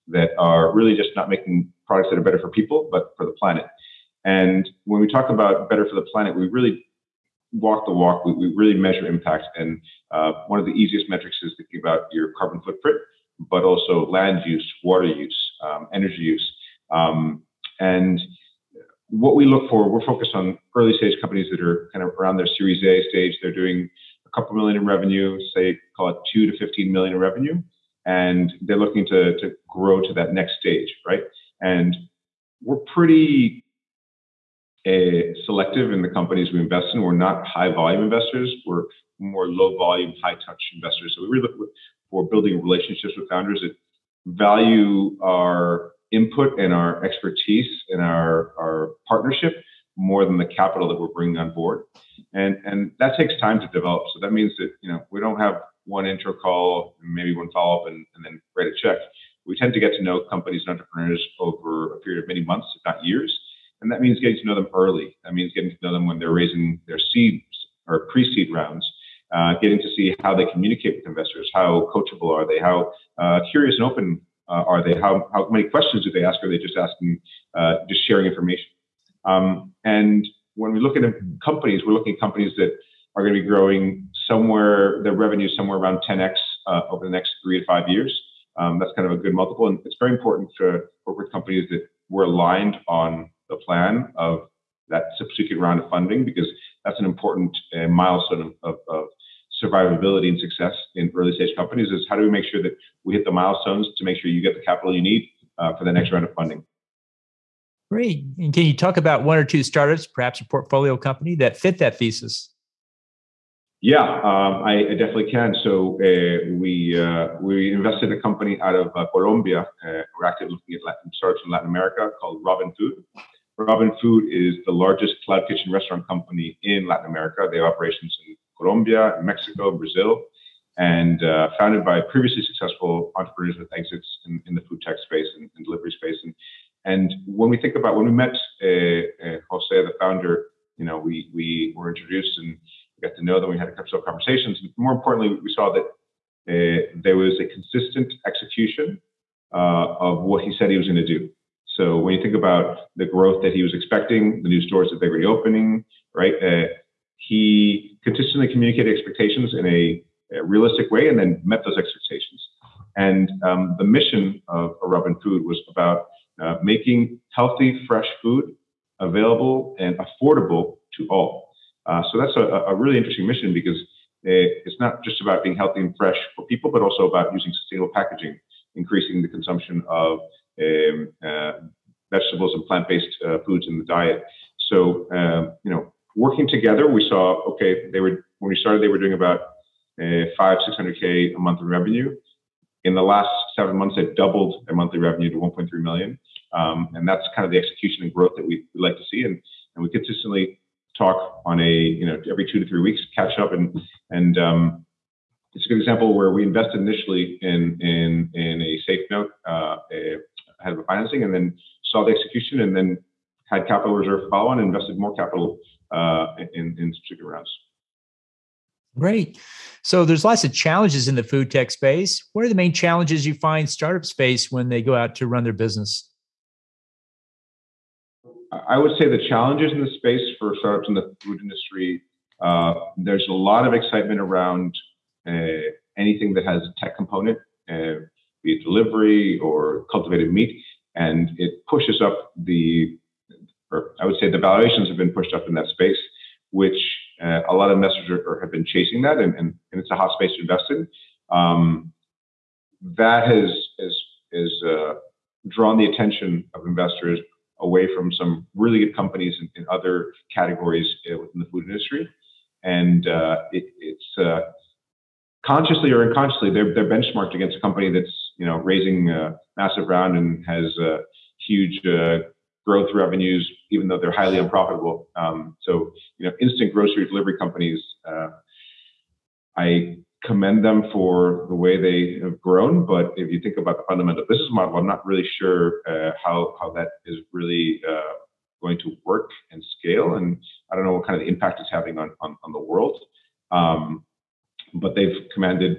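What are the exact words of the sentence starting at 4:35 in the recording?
Um, so you know, instant grocery delivery companies.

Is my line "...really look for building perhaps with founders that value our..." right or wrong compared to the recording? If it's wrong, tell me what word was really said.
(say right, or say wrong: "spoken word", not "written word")
wrong: "relationships", not "perhaps".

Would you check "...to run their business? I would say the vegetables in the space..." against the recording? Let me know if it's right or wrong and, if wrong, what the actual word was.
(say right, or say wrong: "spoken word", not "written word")
wrong: "challenges", not "vegetables".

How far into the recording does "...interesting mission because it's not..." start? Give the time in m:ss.
2:52.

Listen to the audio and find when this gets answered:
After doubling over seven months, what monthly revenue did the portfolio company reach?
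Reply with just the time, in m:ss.
3:15.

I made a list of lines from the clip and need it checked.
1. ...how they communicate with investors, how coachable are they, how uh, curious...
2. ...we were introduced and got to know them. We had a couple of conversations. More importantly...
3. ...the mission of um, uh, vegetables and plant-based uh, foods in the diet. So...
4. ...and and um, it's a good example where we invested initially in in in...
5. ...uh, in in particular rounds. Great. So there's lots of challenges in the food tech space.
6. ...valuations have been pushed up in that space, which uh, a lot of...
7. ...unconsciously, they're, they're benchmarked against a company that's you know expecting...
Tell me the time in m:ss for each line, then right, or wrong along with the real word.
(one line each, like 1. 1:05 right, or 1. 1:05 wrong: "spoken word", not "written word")
1. 1:10 right
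2. 2:21 right
3. 2:59 wrong: "consumption", not "mission"
4. 3:23 right
5. 3:35 right
6. 4:04 right
7. 4:26 wrong: "raising", not "expecting".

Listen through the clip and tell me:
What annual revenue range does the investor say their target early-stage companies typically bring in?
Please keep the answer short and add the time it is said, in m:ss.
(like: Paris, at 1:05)
2 to 15 million, at 0:26.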